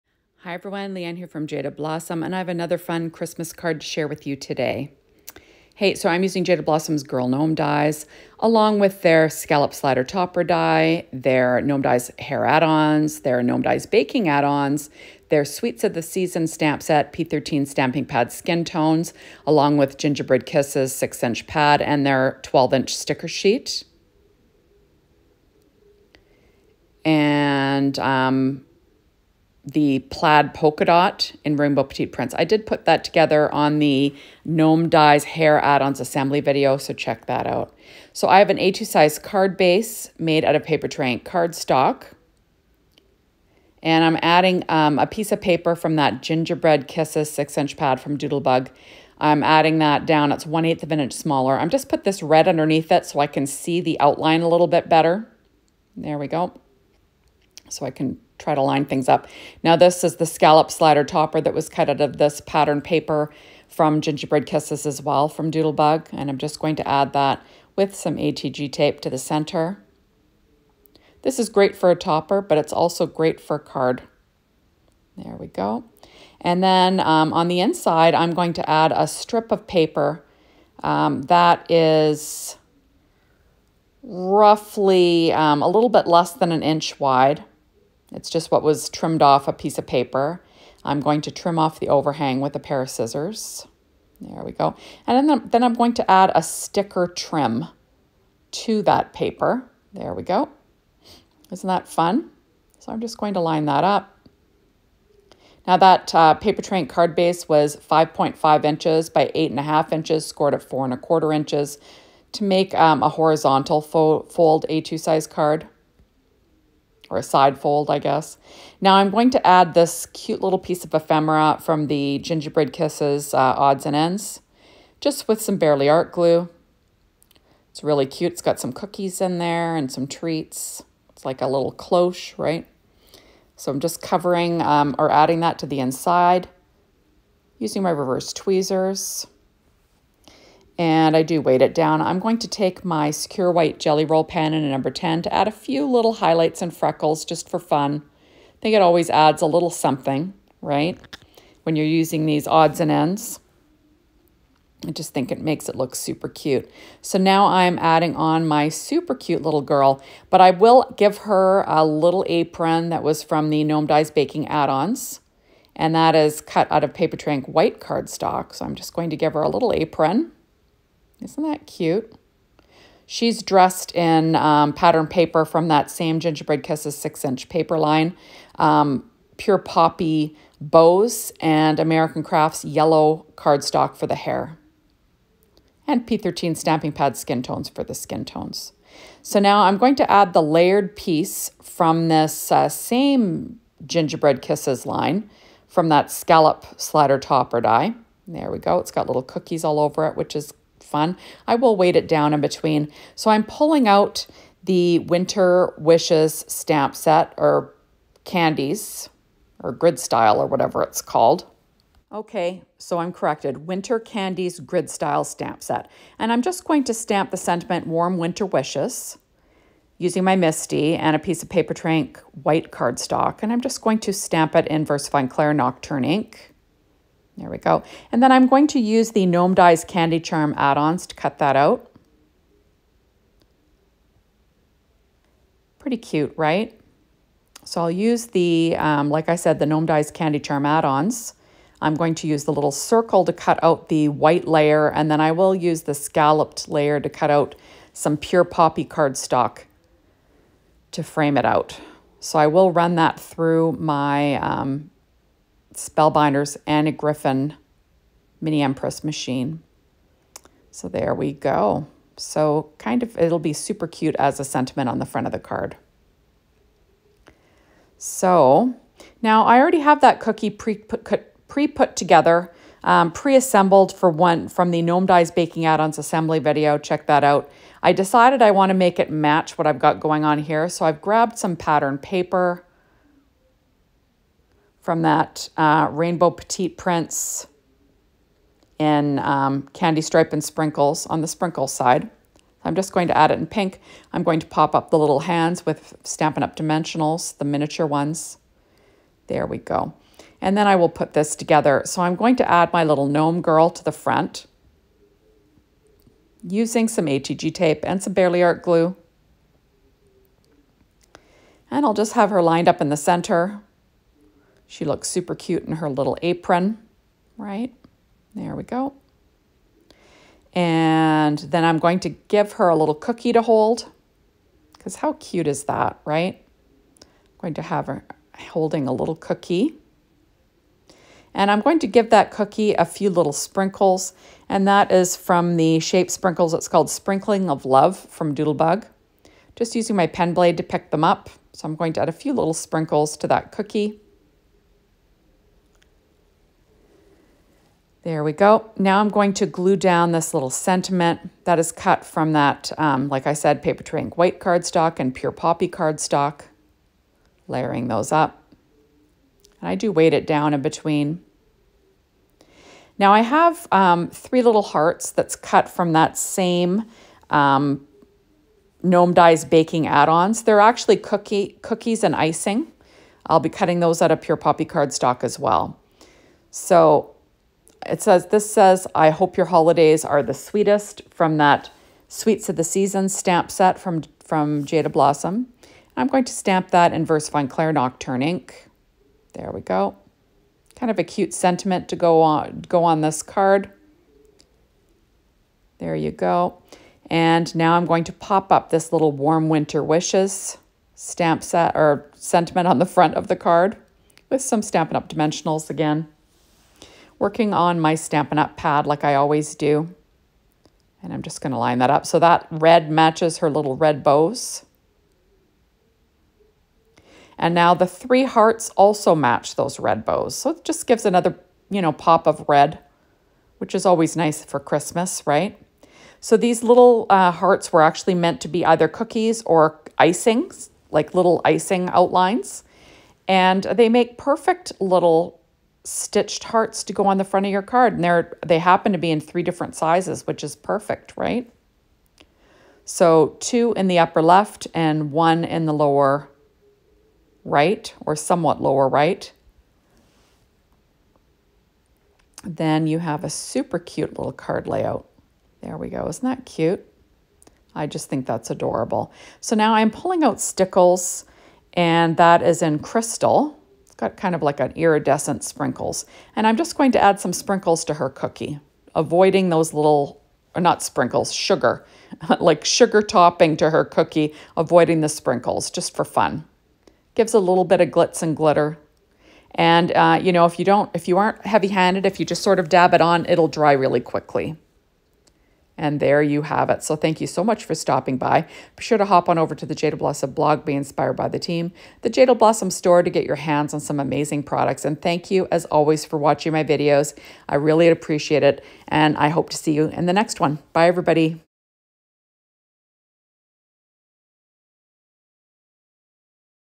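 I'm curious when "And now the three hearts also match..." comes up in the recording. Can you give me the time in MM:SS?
06:57.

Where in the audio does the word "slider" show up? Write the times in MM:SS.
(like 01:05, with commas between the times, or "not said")
00:09, 01:00, 03:16.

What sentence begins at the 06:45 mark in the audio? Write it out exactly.
Dimensionals again working on my Stampin' Up!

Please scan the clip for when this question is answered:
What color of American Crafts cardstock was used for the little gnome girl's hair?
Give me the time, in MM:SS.
03:02.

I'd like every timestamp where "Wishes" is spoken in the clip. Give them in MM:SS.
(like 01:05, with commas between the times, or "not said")
03:25, 03:38, 06:39.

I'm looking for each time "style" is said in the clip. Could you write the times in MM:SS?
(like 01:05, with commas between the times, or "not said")
03:29, 03:34.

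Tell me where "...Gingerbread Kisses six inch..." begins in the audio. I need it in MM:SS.
02:56.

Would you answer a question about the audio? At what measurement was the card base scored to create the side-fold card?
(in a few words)
4 and a quarter inches.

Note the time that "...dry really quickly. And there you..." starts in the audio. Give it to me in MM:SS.
08:03.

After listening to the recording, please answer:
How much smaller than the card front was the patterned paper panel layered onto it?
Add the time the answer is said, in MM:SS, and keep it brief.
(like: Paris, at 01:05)
1/8 of an inch, at 00:50.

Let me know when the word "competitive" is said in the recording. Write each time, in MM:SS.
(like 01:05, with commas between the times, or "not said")
not said.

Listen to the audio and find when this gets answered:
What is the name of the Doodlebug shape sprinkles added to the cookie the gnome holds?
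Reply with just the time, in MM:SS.
05:36.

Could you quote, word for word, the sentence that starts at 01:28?
It's just what was trimmed off a piece of paper.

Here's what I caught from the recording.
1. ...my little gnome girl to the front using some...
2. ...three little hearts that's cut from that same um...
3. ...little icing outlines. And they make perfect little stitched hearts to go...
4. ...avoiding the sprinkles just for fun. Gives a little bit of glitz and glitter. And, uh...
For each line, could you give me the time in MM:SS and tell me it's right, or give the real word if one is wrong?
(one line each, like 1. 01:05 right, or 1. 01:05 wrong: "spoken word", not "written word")
1. 05:02 right
2. 06:04 right
3. 07:11 right
4. 07:54 right.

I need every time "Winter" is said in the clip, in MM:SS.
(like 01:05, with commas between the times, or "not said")
03:24, 03:33, 03:38, 06:39.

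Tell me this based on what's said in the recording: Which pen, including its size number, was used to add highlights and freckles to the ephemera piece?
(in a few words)
Sakura White Gelly Roll number 10.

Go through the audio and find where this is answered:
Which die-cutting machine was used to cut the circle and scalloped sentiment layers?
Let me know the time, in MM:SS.
04:15.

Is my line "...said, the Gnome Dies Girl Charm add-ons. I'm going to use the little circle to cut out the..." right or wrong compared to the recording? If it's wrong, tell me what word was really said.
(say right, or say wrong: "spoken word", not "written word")
wrong: "Candy", not "Girl".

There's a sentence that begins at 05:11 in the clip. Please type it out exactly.
And I'll just have her lined up in the center she looks super cute in her little apron, right?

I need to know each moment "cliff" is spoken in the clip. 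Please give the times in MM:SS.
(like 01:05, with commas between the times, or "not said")
not said.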